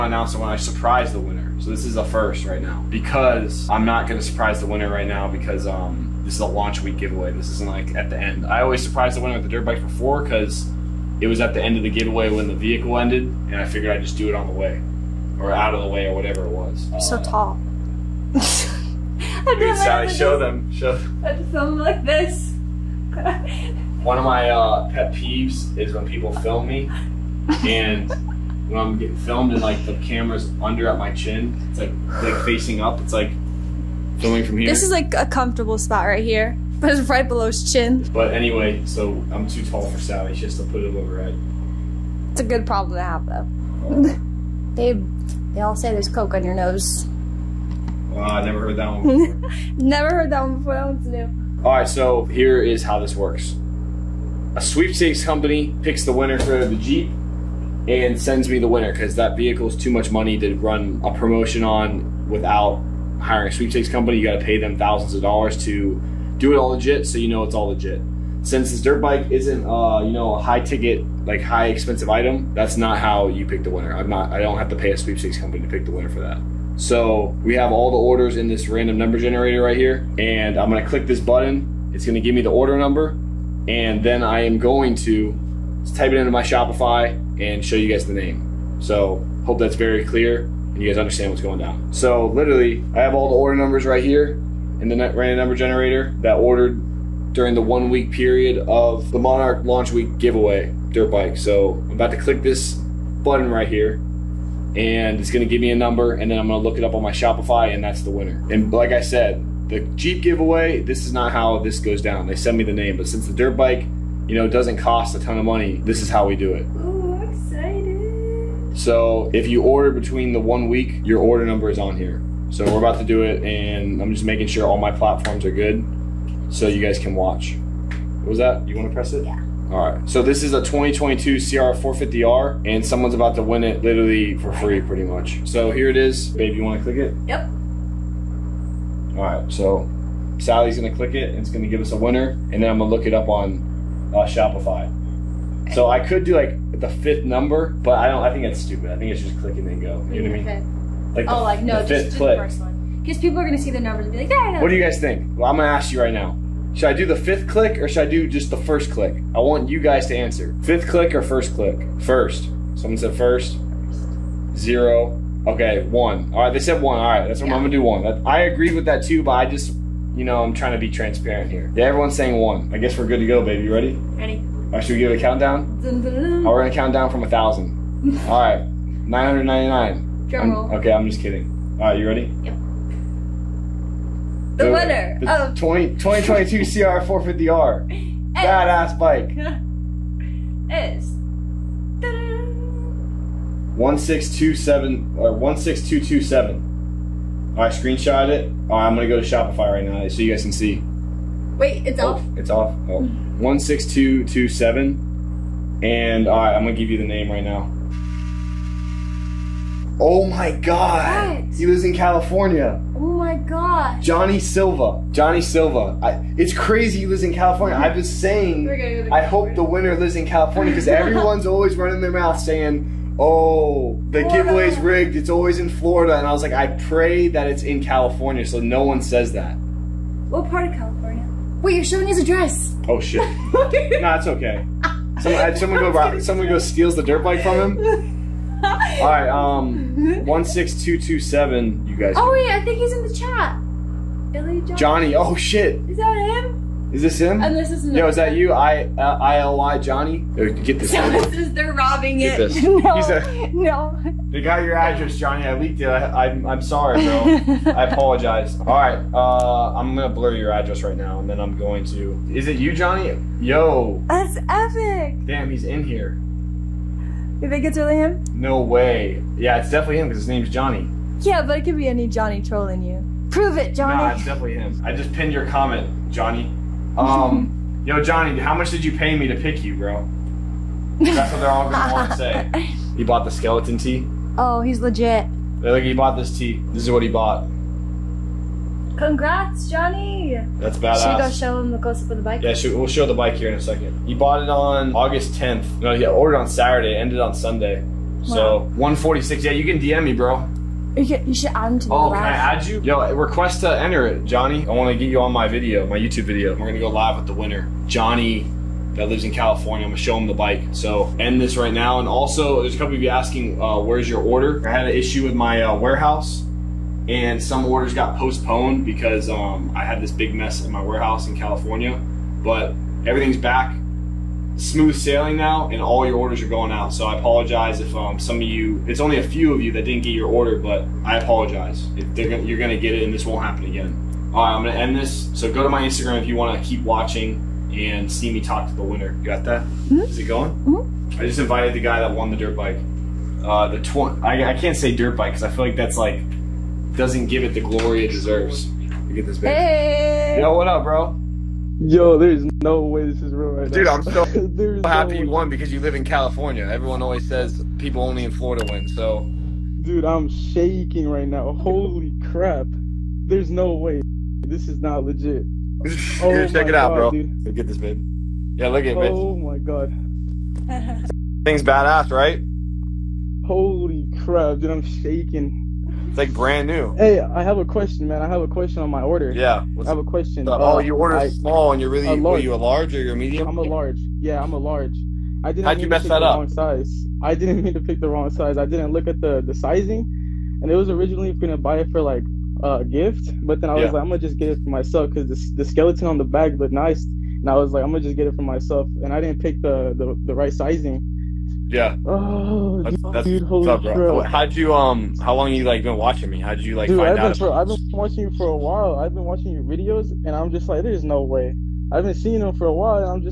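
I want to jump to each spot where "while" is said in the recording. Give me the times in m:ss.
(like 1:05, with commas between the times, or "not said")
6:48, 6:52.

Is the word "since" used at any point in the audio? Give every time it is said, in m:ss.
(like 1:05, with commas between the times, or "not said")
1:08, 1:53.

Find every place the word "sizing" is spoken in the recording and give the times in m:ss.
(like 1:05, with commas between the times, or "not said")
6:29, 6:40.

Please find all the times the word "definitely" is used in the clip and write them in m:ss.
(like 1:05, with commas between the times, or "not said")
4:29, 4:34.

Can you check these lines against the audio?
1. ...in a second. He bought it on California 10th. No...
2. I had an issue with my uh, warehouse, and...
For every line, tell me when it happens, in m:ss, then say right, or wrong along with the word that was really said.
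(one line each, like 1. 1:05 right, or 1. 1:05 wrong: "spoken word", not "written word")
1. 4:53 wrong: "August", not "California"
2. 5:14 right.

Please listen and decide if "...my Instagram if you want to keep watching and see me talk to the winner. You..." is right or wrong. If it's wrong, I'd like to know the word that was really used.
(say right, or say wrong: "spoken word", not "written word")
right.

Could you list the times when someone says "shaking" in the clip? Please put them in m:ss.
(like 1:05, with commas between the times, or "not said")
6:00, 6:14.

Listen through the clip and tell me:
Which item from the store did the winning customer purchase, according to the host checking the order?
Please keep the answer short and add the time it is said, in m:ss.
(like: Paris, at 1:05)
skeleton tee, at 4:43.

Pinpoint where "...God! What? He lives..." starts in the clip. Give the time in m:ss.
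3:30.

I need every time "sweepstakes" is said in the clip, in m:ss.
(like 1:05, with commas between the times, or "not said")
0:54, 1:03, 1:14.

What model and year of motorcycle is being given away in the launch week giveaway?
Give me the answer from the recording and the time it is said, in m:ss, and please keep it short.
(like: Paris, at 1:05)
2022 CR450R, at 2:10.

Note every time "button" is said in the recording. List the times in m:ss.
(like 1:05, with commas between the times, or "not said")
1:21, 1:43.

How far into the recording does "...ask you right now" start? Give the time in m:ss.
2:35.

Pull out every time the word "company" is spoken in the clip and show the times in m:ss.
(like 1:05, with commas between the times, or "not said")
0:55, 1:03, 1:15.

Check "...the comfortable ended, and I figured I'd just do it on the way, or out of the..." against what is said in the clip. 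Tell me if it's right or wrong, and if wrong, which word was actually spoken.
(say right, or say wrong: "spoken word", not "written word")
wrong: "vehicle", not "comfortable".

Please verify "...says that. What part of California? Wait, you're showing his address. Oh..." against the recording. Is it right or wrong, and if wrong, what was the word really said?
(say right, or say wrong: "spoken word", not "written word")
right.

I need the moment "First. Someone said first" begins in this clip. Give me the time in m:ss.
2:41.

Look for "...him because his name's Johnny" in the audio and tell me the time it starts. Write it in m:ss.
4:29.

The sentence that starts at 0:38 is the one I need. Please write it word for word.
But anyway, so I'm too tall for Sally.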